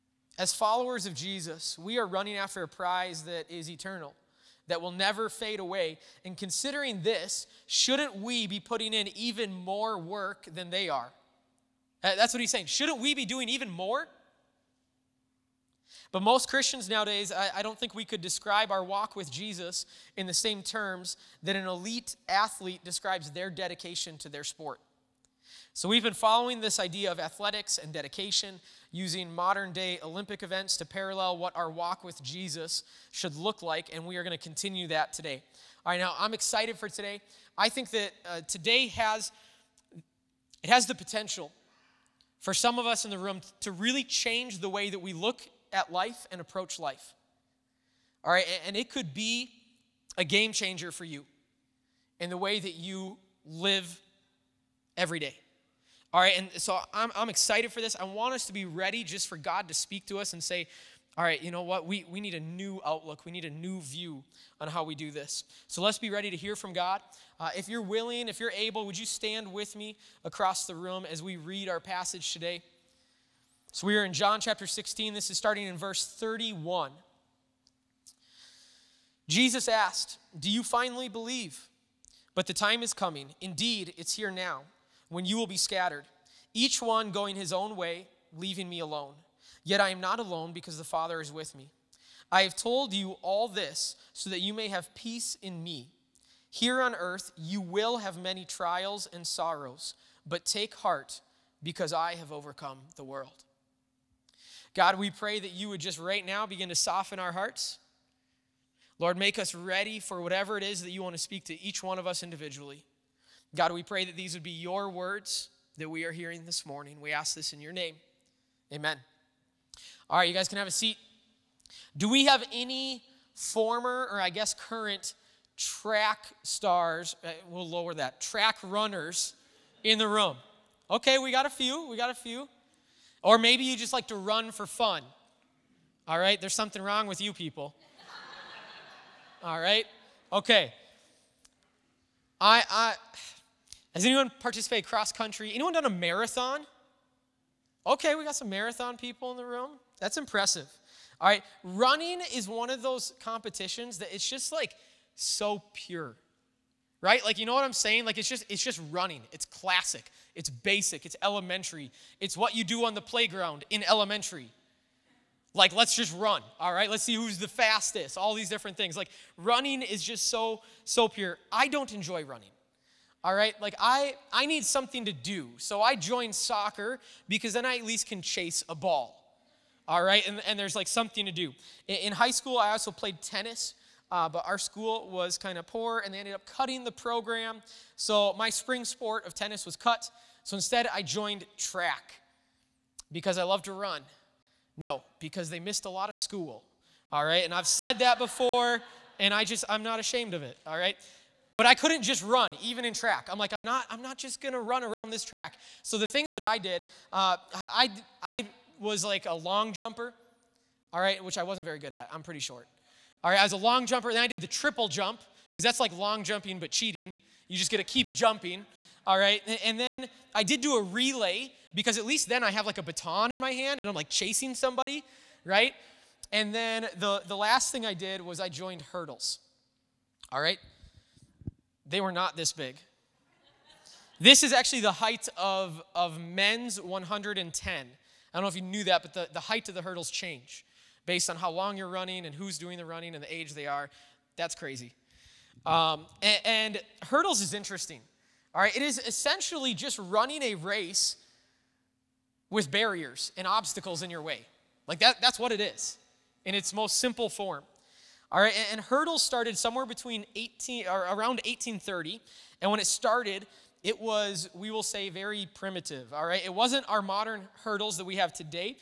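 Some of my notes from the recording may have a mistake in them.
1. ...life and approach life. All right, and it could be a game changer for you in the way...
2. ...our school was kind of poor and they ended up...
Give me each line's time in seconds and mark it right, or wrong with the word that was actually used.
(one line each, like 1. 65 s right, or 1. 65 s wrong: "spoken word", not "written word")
1. 45 s right
2. 184 s right.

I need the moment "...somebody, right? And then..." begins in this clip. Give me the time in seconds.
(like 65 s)
224 s.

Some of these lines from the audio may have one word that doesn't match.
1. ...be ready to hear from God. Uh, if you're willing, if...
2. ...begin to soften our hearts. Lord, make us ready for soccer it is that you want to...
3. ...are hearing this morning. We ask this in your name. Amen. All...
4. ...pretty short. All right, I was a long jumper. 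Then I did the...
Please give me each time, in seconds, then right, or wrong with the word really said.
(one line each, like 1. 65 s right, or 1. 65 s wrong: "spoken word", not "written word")
1. 65 s right
2. 106 s wrong: "whatever", not "soccer"
3. 116 s right
4. 212 s right.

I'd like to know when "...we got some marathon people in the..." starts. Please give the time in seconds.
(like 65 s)
148 s.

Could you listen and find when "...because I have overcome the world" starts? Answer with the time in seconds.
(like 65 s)
101 s.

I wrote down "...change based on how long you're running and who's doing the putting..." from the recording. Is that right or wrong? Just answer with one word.
wrong.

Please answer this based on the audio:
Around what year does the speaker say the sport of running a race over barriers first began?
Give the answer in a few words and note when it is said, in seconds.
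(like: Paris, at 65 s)
1830, at 261 s.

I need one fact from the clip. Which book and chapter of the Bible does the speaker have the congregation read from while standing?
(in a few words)
John 16.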